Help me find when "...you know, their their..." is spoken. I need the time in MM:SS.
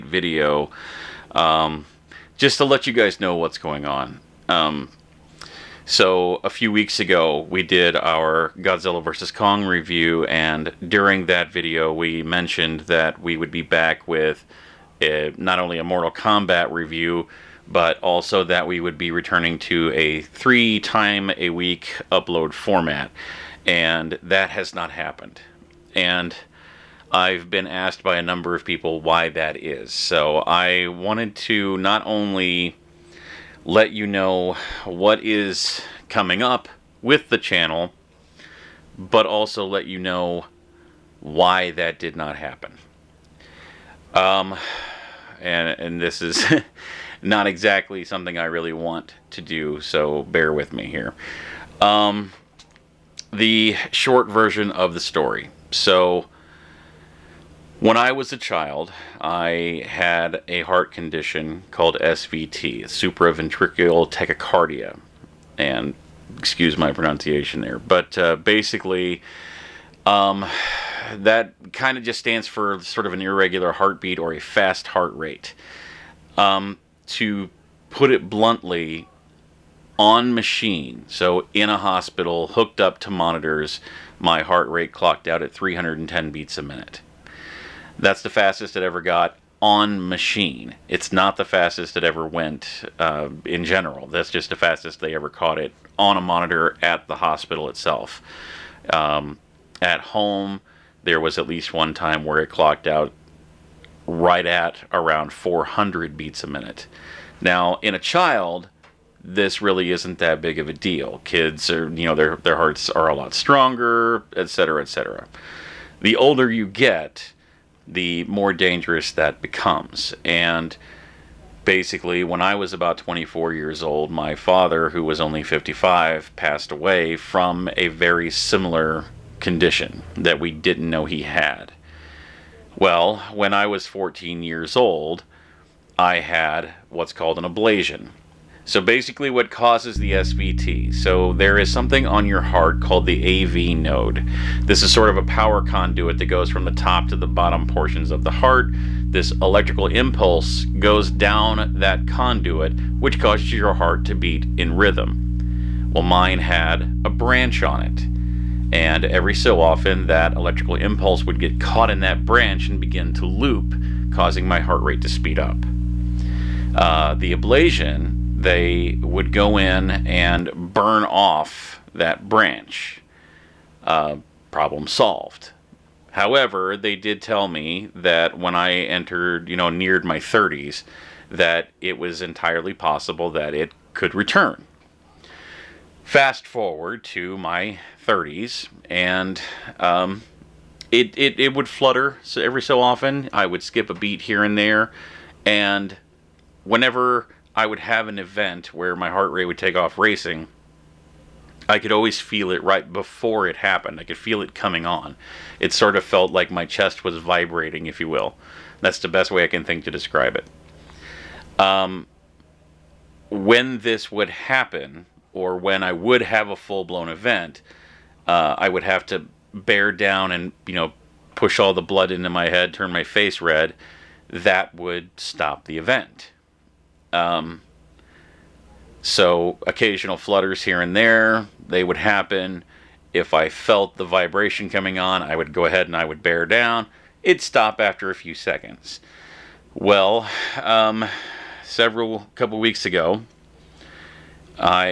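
01:51.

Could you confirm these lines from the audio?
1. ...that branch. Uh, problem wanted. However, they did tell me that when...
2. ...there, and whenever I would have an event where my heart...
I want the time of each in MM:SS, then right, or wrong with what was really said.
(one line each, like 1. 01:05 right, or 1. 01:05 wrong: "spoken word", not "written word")
1. 02:51 wrong: "solved", not "wanted"
2. 03:14 right.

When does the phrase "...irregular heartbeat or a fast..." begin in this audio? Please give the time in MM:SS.
01:13.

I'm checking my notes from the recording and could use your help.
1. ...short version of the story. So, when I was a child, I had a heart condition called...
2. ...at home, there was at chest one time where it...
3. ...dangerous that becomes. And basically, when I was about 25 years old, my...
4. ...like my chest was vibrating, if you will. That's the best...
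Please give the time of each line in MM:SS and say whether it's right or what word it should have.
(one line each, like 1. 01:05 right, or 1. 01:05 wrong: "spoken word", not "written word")
1. 00:53 right
2. 01:39 wrong: "least", not "chest"
3. 01:58 wrong: "24", not "25"
4. 03:26 right.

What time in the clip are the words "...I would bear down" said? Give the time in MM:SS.
03:55.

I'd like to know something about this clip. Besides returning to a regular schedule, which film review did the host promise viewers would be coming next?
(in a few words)
Mortal Kombat.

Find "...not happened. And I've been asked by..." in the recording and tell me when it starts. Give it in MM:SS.
00:24.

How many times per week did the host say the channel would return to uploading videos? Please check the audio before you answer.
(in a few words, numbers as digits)
3.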